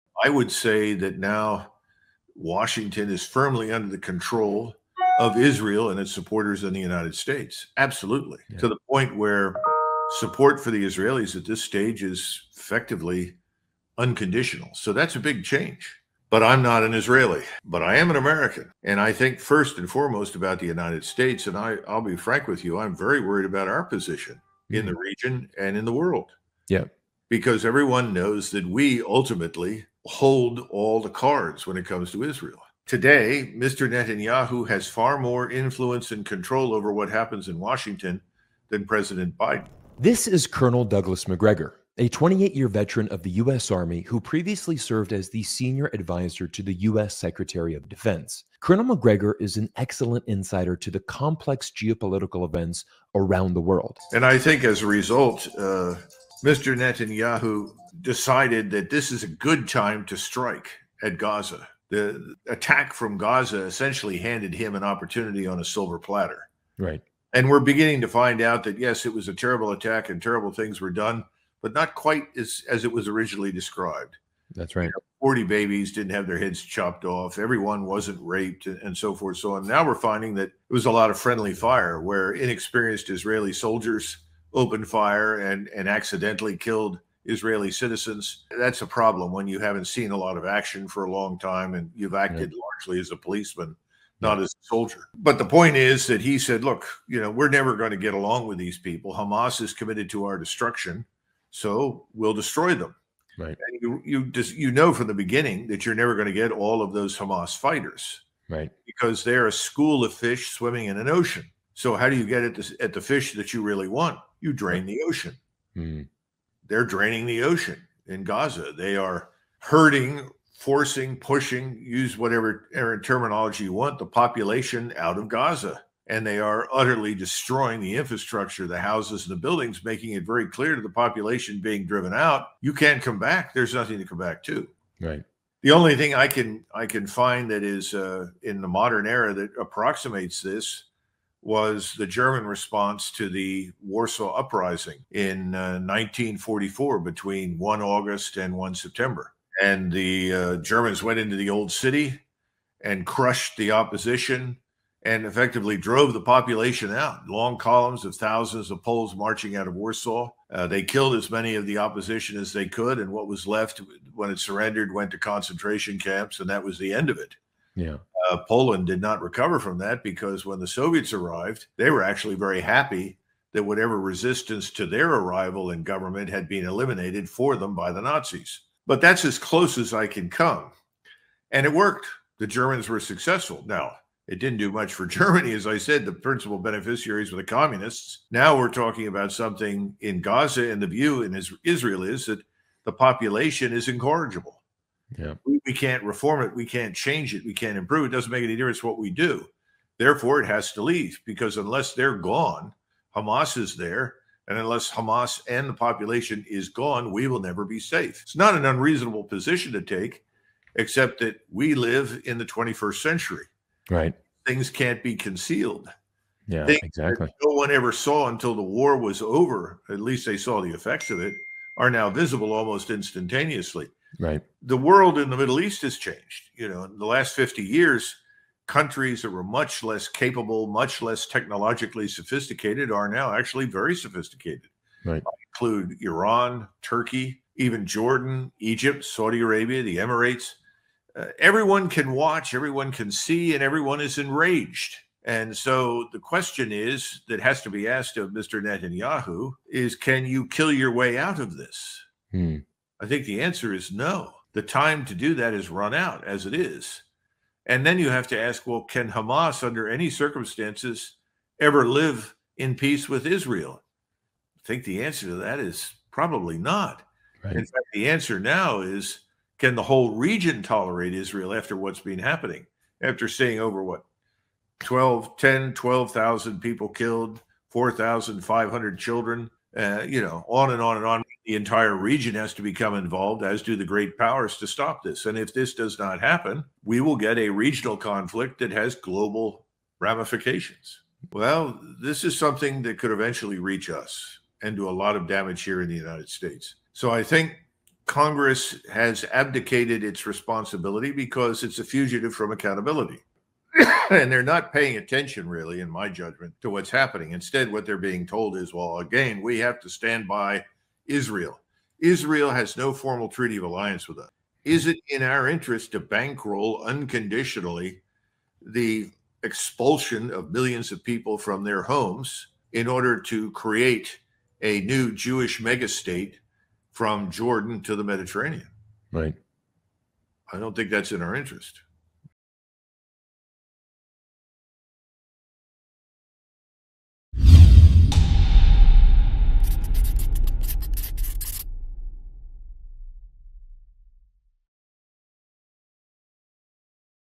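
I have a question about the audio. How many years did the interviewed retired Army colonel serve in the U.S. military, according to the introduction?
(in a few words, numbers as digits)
28.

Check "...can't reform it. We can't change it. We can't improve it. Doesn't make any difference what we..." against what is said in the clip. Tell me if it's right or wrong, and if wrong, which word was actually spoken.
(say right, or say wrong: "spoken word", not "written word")
right.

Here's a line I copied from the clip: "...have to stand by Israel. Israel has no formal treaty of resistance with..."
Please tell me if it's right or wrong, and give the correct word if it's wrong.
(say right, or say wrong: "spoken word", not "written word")
wrong: "alliance", not "resistance".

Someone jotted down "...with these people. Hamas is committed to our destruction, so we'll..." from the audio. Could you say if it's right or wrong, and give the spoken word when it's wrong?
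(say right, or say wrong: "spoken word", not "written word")
right.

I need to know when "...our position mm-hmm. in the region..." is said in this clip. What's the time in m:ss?
0:23.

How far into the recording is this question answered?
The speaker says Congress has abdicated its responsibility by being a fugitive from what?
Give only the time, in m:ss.
5:02.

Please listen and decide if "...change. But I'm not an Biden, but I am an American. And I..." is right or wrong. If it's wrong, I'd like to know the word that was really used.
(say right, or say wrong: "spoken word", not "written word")
wrong: "Israeli", not "Biden".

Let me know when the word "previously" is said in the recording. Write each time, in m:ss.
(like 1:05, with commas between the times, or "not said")
0:44.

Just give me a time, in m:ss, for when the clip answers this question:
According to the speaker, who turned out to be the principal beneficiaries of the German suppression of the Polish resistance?
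3:07.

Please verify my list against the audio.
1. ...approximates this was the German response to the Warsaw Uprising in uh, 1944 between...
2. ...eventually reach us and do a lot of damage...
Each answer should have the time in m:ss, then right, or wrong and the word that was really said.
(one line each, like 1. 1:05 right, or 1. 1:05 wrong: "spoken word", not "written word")
1. 2:19 right
2. 4:53 right.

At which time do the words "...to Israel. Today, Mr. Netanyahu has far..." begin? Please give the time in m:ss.
0:32.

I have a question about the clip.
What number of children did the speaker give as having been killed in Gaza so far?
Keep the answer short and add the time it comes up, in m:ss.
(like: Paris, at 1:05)
4,500, at 4:37.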